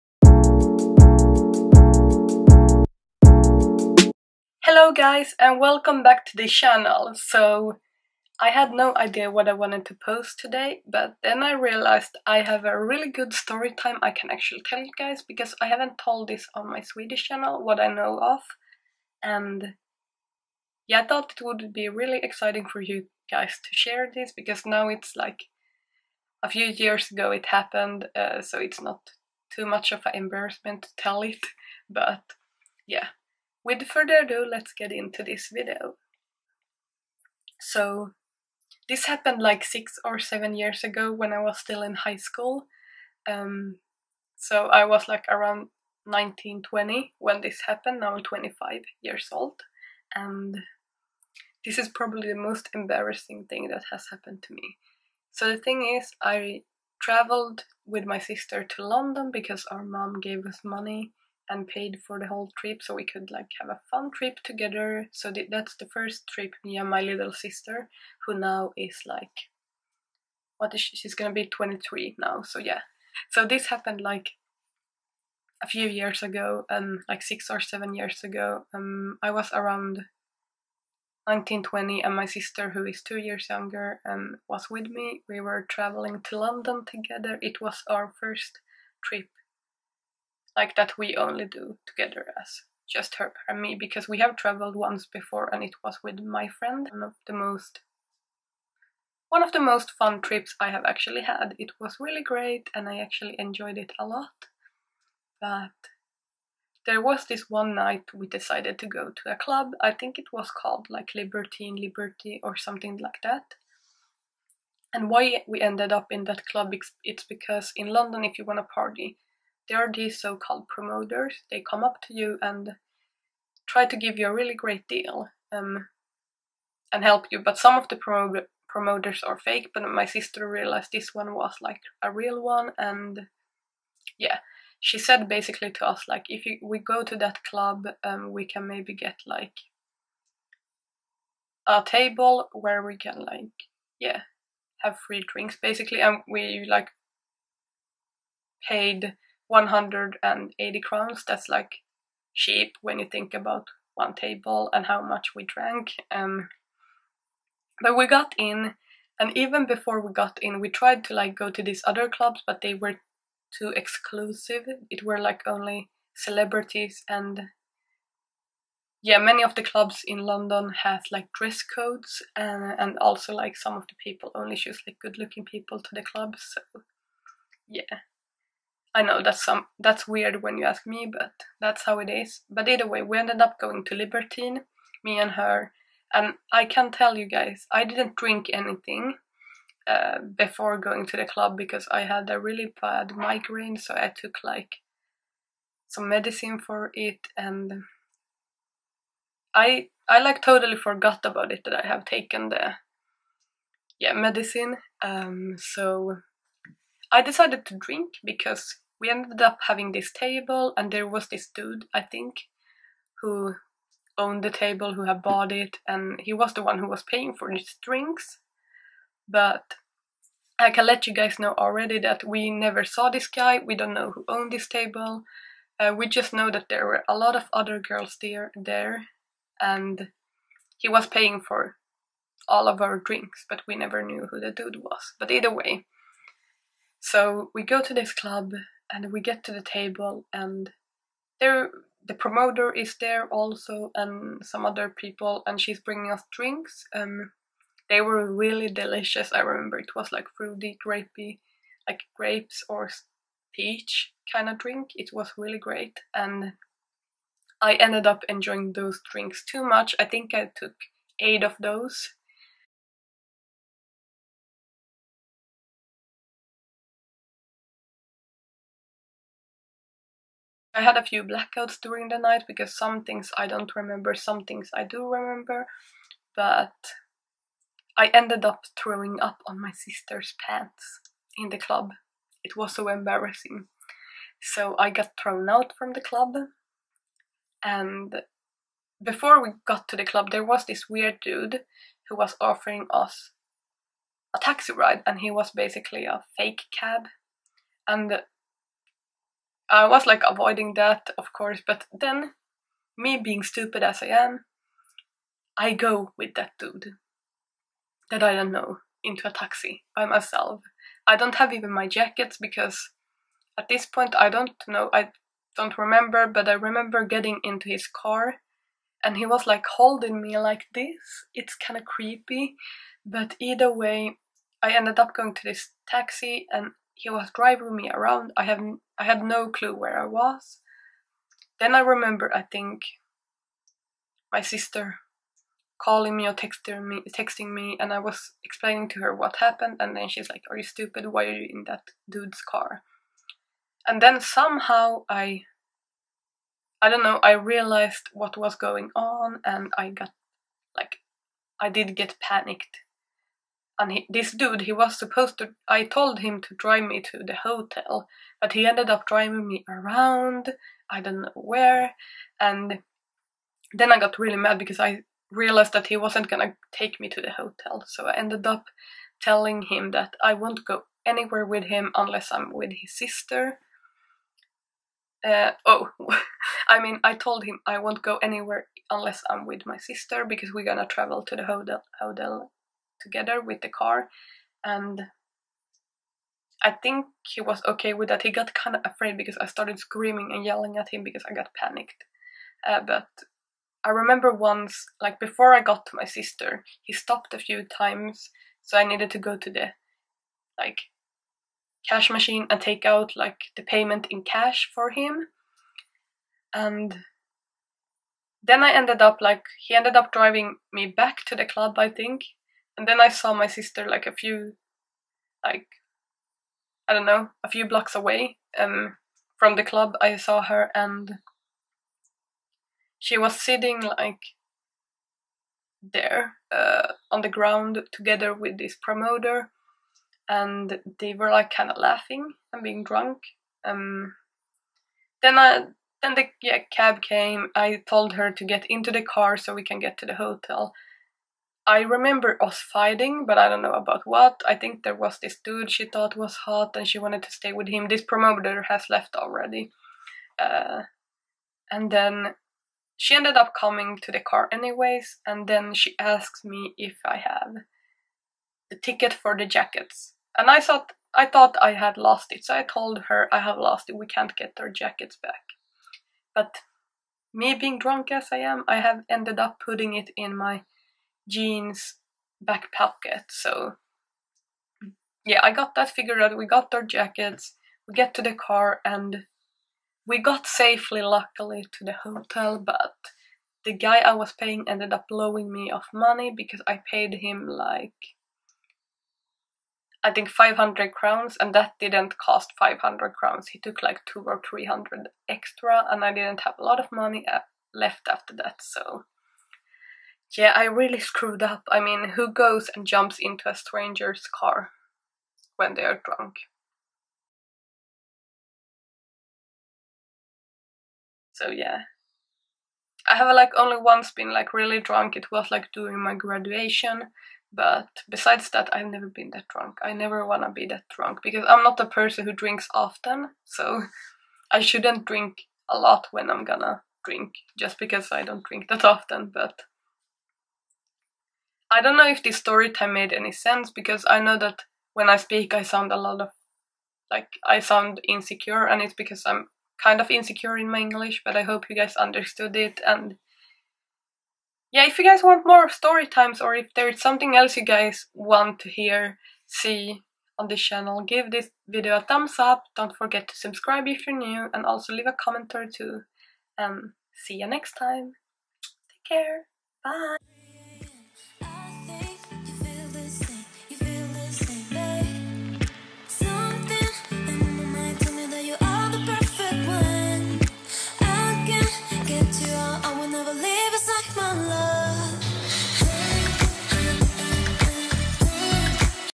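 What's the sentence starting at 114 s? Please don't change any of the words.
And why we ended up in that club, it's because in London, if you want to party, there are these so-called promoters.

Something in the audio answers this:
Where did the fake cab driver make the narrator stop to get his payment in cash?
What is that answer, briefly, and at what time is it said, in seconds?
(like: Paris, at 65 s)
Cash machine, at 401 s.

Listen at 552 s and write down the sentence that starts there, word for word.
Don't forget to subscribe if you're new, and also leave a comment or two.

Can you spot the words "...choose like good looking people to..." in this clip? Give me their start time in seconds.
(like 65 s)
174 s.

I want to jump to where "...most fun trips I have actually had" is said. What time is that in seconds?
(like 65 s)
99 s.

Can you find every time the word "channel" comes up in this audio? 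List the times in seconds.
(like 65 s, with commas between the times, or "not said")
6 s, 17 s, 550 s.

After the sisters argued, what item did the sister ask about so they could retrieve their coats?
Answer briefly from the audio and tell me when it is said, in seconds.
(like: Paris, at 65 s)
The ticket for the jackets, at 458 s.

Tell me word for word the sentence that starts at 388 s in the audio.
He got kind of afraid because I started screaming and yelling at him because I got panicked.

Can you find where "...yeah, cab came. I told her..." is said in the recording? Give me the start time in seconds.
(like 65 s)
436 s.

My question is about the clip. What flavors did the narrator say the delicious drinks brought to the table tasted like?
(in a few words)
Grapes or peach.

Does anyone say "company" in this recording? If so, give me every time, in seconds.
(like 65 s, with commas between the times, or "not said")
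not said.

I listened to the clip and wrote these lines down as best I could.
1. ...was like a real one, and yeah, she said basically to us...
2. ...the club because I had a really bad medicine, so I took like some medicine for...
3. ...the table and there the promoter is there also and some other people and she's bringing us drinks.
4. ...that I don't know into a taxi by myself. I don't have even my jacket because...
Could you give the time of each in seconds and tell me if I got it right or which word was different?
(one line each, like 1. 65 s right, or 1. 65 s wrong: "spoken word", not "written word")
1. 131 s right
2. 191 s wrong: "migraine", not "medicine"
3. 239 s right
4. 308 s right.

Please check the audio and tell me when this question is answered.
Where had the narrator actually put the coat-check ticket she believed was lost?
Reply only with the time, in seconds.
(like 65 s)
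471 s.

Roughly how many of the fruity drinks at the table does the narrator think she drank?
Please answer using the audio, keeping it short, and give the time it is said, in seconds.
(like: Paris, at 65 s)
8, at 261 s.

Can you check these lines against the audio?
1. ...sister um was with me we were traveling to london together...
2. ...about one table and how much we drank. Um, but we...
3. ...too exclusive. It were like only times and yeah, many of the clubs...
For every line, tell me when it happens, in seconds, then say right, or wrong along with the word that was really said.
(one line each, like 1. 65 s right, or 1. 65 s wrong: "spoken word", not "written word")
1. 83 s wrong: "younger", not "sister"
2. 153 s right
3. 163 s wrong: "celebrities", not "times".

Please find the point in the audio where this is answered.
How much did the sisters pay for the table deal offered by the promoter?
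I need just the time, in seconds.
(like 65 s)
149 s.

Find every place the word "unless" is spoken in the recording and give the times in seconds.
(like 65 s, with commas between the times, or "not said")
371 s, 378 s.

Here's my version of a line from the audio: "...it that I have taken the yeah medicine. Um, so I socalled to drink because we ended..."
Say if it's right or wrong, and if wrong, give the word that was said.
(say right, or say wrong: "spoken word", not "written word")
wrong: "decided", not "socalled".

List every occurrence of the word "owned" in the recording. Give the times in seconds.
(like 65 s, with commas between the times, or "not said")
214 s, 224 s.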